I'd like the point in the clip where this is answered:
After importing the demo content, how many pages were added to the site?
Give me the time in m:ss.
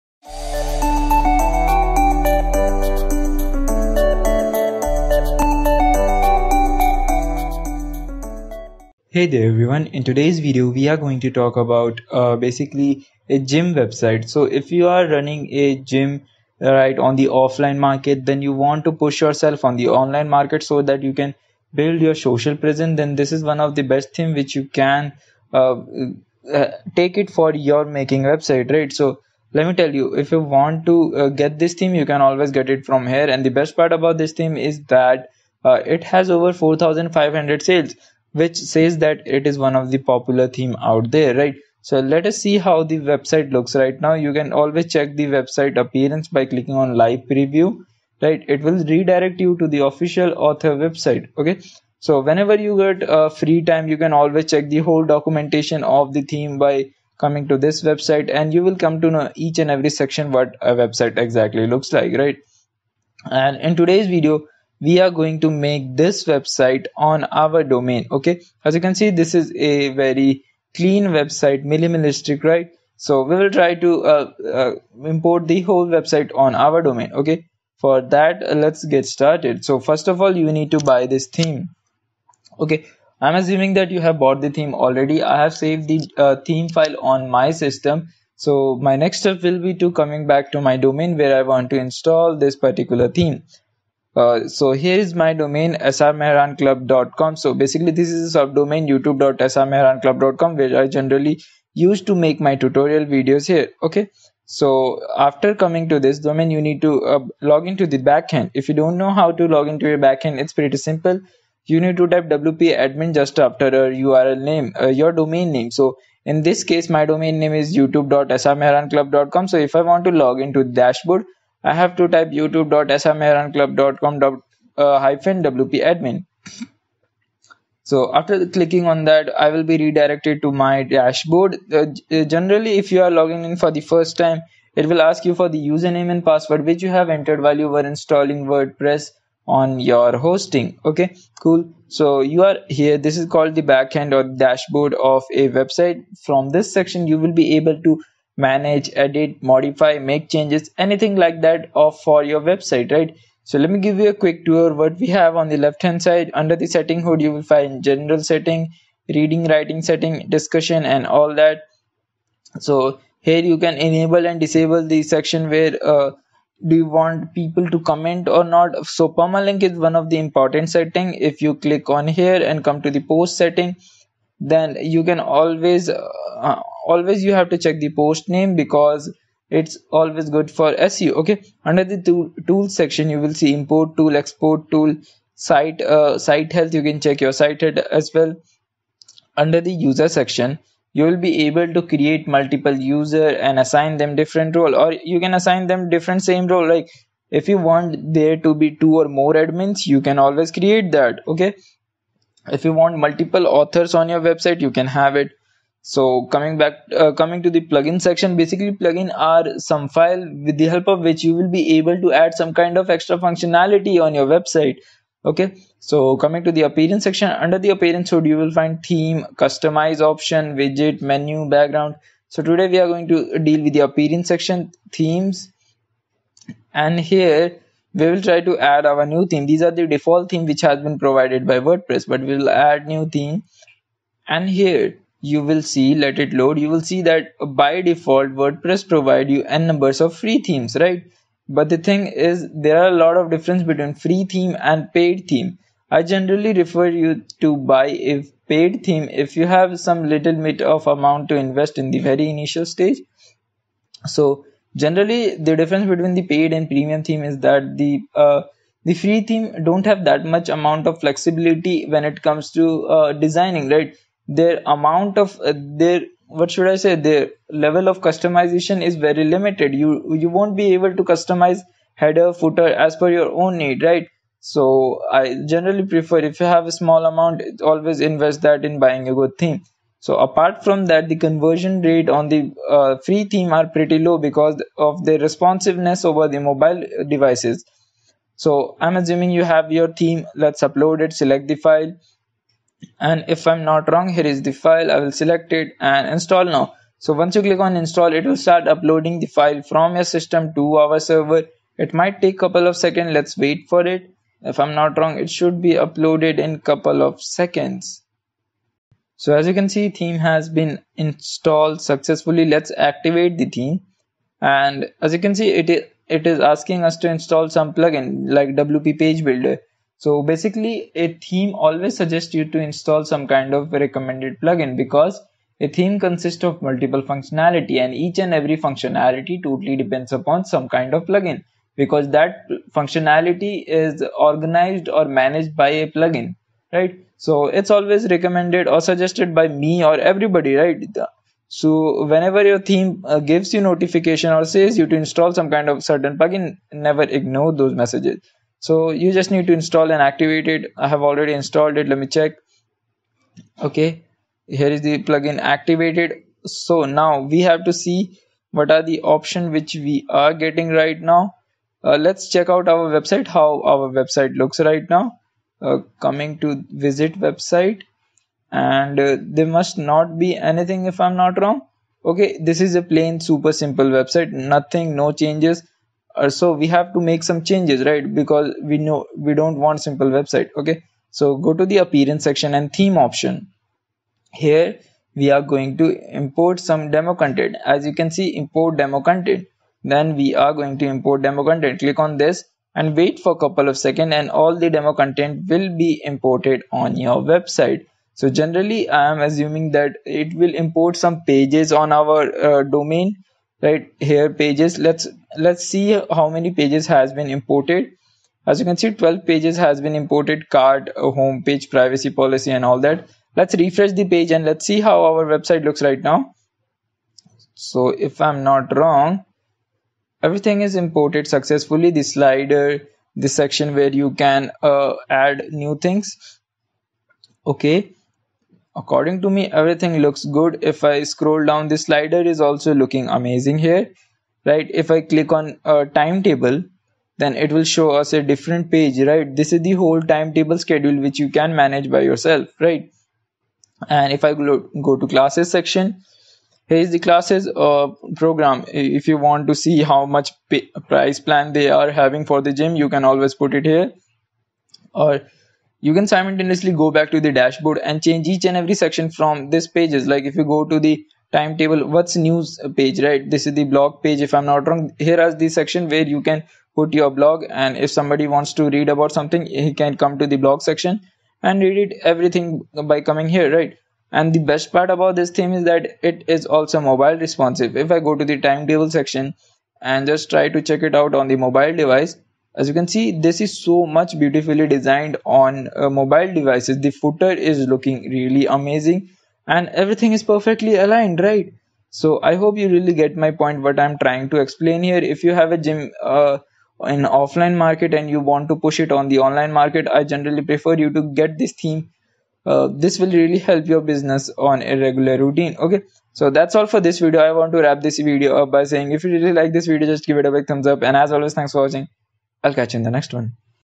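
6:49.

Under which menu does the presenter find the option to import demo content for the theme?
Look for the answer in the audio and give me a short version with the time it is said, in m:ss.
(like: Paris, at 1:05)
Theme option, at 6:22.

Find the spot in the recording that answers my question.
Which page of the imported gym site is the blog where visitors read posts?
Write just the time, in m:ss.
7:41.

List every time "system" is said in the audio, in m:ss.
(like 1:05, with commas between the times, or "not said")
1:27, 5:00.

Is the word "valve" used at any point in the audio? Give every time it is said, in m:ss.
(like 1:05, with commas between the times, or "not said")
not said.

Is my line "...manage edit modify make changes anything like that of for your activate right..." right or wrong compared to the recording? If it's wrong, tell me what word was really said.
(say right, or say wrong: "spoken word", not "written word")
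wrong: "website", not "activate".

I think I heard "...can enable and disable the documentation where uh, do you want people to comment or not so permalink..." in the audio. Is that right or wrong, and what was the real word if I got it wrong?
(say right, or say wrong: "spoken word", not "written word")
wrong: "section", not "documentation".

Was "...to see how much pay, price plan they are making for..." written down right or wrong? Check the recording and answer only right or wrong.
wrong.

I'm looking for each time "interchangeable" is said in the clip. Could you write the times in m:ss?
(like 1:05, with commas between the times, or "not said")
not said.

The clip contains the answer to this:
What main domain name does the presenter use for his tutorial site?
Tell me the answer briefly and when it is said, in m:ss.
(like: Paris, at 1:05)
srmehranclub.com, at 1:35.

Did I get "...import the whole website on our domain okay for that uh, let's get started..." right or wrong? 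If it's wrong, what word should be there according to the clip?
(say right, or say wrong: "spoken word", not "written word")
right.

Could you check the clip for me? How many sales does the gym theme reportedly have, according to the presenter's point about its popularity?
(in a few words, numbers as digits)
4500.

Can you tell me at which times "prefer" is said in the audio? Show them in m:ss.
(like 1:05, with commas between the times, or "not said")
4:35, 8:20.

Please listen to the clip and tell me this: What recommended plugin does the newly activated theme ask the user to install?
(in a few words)
WP Page Builder.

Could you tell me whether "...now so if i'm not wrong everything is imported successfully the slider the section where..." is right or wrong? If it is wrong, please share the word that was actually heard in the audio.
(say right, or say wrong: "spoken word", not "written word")
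right.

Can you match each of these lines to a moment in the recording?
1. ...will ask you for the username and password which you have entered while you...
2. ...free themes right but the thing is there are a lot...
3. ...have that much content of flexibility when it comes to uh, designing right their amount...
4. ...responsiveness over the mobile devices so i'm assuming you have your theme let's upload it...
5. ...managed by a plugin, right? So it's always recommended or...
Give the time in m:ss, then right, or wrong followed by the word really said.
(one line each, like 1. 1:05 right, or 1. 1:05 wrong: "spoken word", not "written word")
1. 2:14 right
2. 4:00 right
3. 4:19 wrong: "amount", not "content"
4. 4:45 right
5. 5:35 right.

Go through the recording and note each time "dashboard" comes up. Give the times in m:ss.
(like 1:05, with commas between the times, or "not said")
2:00, 2:10, 2:24, 7:37.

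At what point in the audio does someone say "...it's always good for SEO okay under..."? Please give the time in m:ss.
2:59.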